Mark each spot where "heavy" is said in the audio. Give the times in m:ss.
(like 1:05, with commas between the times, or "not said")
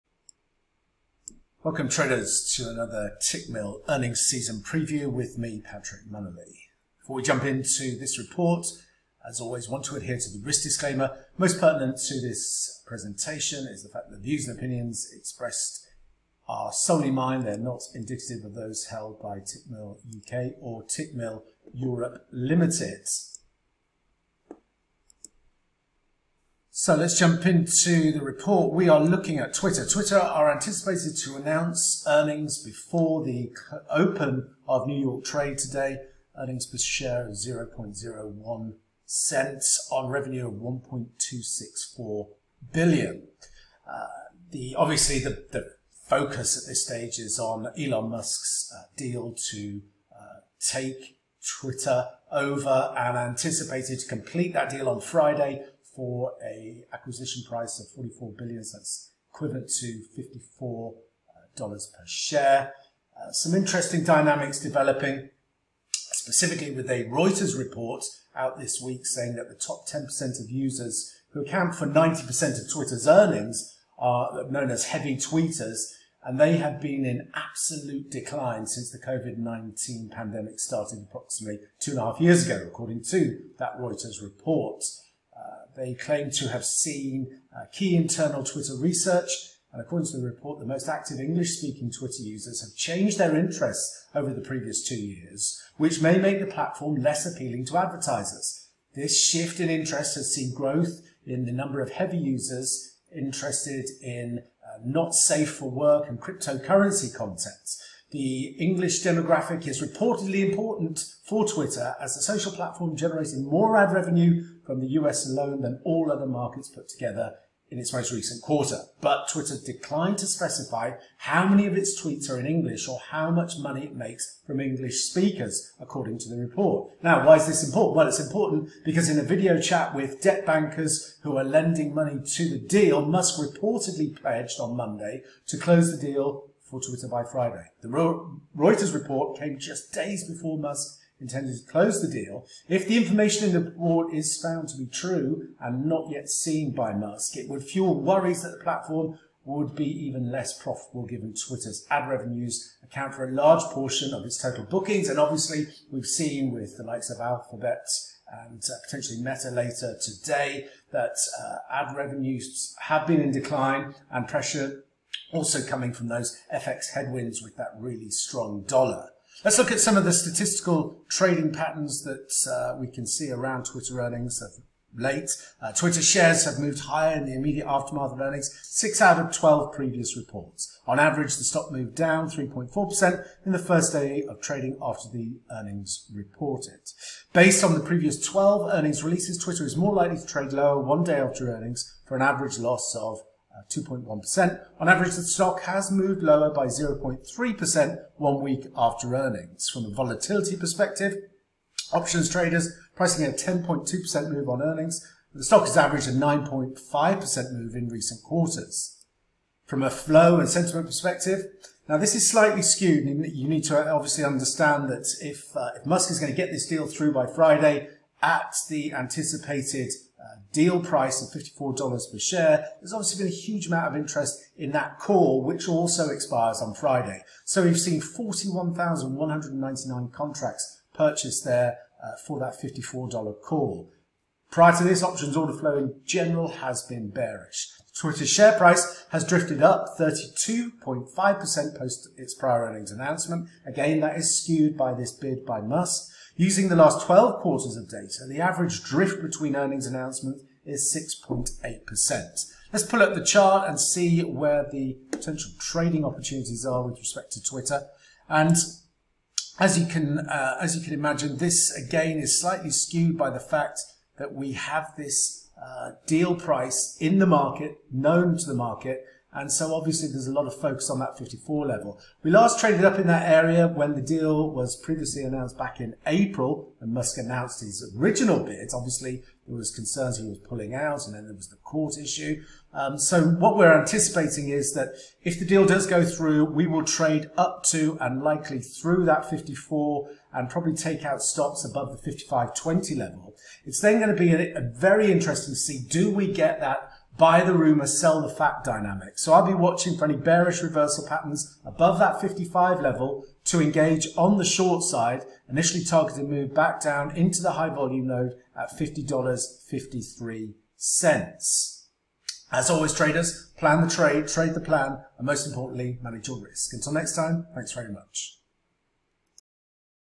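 1:14, 1:41.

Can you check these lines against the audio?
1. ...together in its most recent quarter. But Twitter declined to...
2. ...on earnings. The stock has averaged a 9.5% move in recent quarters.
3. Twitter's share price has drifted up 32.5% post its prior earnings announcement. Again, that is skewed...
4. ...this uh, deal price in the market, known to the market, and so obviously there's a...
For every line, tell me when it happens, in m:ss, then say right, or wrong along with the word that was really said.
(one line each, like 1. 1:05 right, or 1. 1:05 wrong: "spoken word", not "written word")
1. 1:56 right
2. 3:24 right
3. 3:57 right
4. 4:24 right.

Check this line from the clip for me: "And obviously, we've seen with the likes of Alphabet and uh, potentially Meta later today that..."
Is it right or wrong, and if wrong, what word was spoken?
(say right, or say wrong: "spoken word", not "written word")
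right.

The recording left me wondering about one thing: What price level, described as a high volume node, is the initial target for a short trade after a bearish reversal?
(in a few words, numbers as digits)
$50.53.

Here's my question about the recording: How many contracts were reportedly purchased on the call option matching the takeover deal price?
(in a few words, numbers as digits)
41,199.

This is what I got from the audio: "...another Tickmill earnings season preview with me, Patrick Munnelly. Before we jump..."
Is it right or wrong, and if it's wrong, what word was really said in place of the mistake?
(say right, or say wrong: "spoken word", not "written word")
right.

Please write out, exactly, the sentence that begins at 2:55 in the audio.
Uh, Twitter shares have moved higher in the immediate aftermath of earnings, six out of 12 previous reports.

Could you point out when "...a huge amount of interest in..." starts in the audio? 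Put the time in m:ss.
3:43.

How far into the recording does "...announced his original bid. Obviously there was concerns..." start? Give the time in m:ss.
4:37.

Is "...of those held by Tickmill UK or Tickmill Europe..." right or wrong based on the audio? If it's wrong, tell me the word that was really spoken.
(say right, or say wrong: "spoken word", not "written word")
right.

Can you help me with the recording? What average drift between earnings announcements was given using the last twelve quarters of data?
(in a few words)
6.8%.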